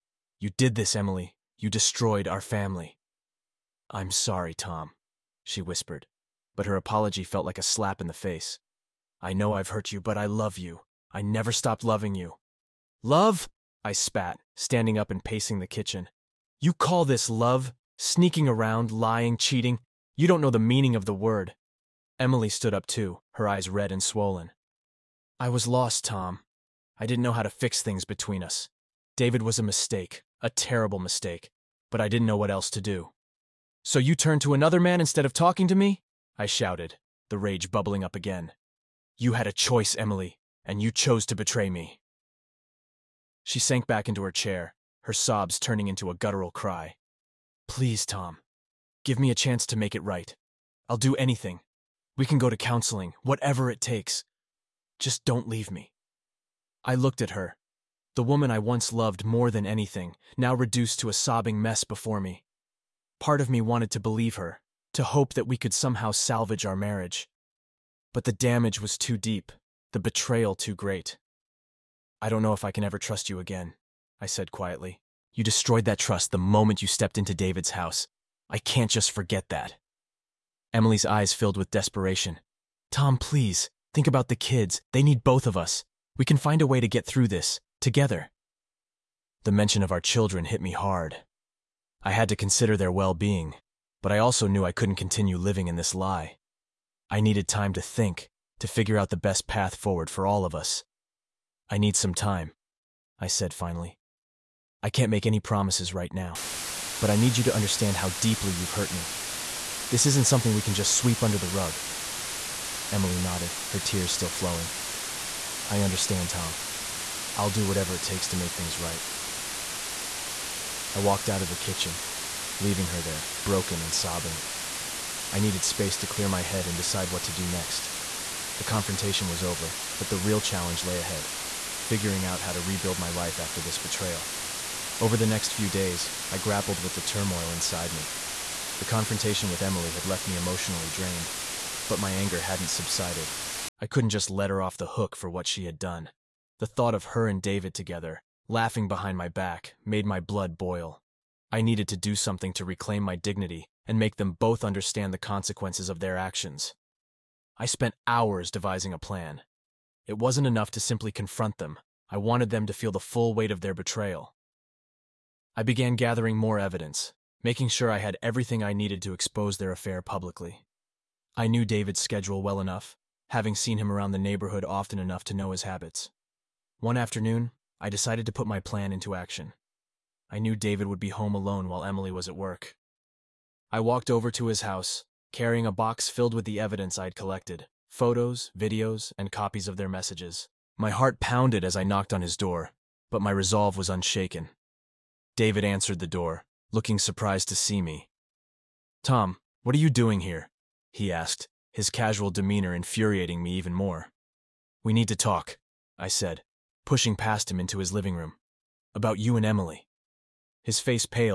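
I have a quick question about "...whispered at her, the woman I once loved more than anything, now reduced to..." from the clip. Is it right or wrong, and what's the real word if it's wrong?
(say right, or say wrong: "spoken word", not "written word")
wrong: "looked", not "whispered".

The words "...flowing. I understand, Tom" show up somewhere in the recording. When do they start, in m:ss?
1:54.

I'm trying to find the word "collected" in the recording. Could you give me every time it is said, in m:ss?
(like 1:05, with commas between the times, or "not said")
3:07.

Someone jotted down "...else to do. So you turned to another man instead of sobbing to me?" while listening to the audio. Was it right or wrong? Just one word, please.
wrong.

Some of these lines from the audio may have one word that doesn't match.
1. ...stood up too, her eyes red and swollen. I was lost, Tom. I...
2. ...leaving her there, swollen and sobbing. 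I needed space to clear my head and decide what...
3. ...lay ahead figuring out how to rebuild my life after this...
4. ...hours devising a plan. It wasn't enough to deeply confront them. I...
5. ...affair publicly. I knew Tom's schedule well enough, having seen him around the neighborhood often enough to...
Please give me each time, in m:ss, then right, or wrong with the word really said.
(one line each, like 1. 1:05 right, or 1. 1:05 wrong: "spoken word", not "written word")
1. 0:22 right
2. 2:02 wrong: "broken", not "swollen"
3. 2:10 right
4. 2:38 wrong: "simply", not "deeply"
5. 2:49 wrong: "David", not "Tom".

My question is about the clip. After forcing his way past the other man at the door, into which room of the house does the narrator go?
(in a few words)
living room.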